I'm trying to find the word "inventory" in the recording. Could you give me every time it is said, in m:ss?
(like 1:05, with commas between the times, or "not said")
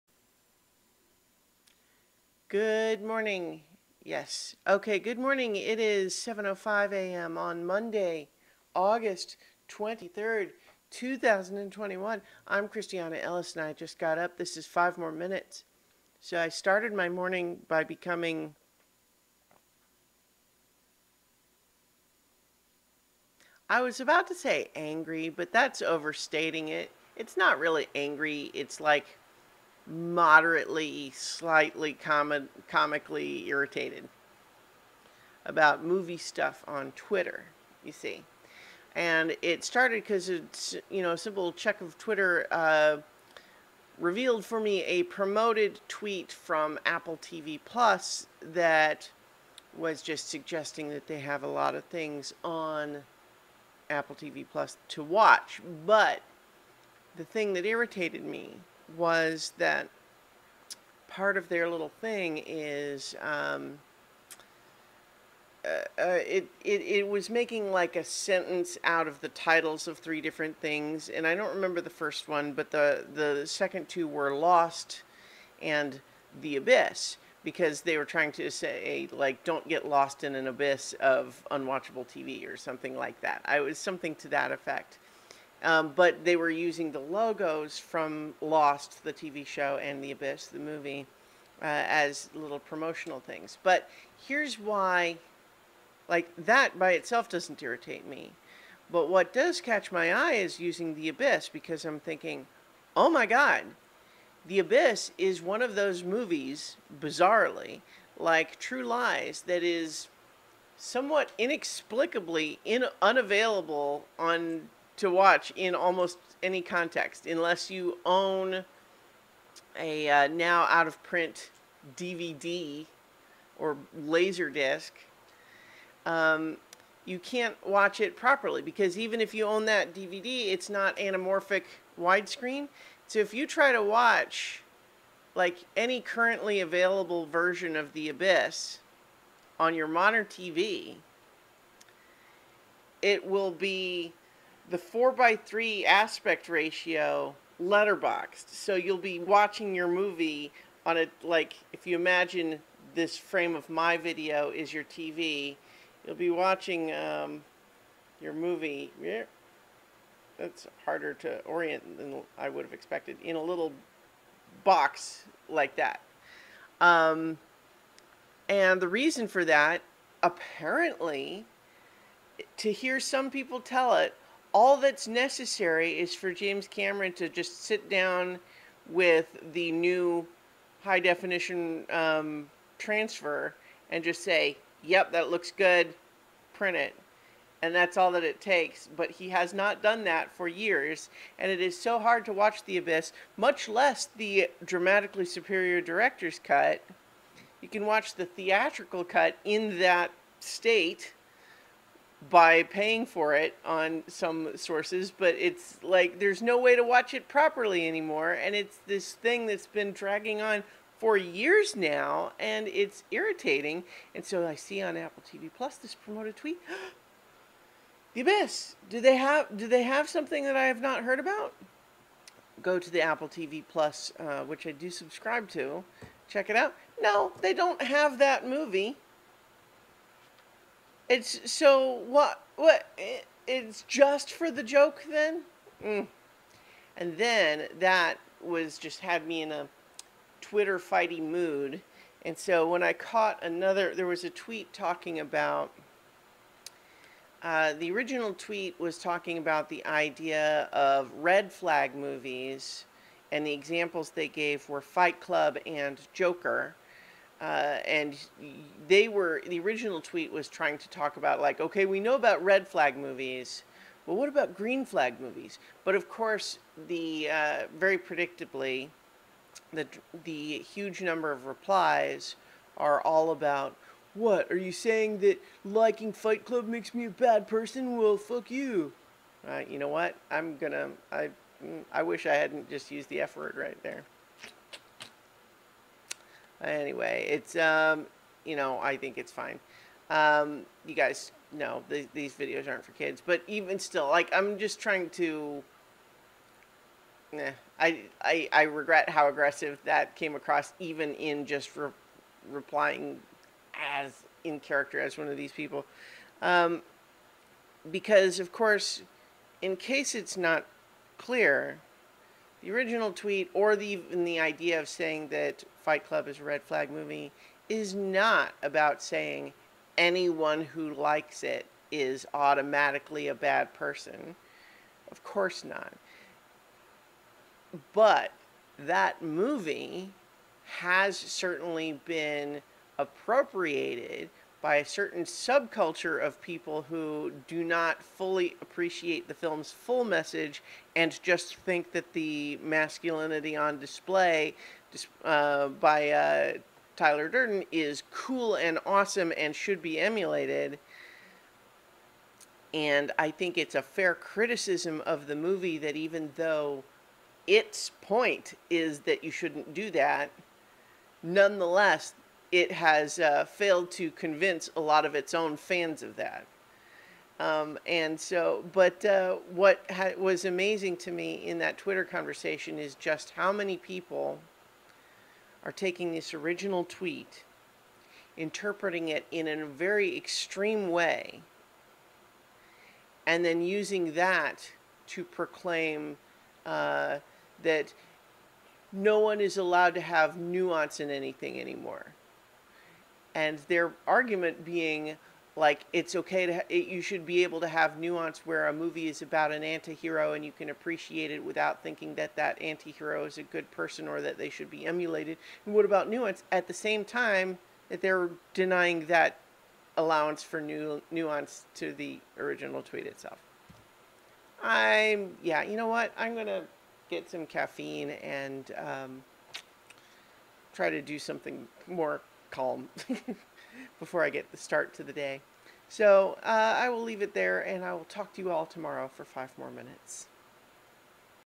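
not said.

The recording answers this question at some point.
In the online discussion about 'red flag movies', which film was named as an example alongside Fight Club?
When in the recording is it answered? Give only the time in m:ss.
4:16.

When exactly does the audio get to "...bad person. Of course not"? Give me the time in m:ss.
5:23.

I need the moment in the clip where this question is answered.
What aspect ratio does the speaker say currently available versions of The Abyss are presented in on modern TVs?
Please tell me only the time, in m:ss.
2:24.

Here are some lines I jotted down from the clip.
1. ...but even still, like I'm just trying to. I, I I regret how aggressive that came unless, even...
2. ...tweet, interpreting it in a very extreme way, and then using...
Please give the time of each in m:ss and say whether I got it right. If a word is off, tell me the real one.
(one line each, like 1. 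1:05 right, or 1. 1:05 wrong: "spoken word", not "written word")
1. 4:53 wrong: "across", not "unless"
2. 6:16 right.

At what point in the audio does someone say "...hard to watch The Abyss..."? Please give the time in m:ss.
3:11.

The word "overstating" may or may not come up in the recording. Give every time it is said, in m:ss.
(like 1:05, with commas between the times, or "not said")
0:25.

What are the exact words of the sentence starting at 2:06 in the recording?
Um, you can't watch it properly because even if you own that DVD, it's not anamorphic widescreen.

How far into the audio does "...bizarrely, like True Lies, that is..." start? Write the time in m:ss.
1:46.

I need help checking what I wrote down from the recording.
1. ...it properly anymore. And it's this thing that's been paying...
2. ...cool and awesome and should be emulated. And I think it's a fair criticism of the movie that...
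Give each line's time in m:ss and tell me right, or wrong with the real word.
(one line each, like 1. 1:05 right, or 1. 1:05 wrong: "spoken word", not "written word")
1. 3:27 wrong: "dragging", not "paying"
2. 5:48 right.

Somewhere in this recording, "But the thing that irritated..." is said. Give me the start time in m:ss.
0:55.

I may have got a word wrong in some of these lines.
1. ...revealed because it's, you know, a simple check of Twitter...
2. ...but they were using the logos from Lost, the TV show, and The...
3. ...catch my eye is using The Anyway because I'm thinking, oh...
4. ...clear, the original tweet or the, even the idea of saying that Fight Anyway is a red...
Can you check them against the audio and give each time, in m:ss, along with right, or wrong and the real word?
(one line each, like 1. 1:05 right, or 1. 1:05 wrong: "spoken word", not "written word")
1. 0:39 wrong: "started", not "revealed"
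2. 1:25 right
3. 1:39 wrong: "Abyss", not "Anyway"
4. 5:11 wrong: "Club", not "Anyway".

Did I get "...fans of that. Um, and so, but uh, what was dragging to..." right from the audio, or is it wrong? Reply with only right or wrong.
wrong.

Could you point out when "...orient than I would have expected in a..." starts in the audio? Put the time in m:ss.
2:41.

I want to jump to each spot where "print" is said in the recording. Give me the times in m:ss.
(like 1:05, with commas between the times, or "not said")
2:01, 3:06.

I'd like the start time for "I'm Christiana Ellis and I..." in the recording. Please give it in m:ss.
0:12.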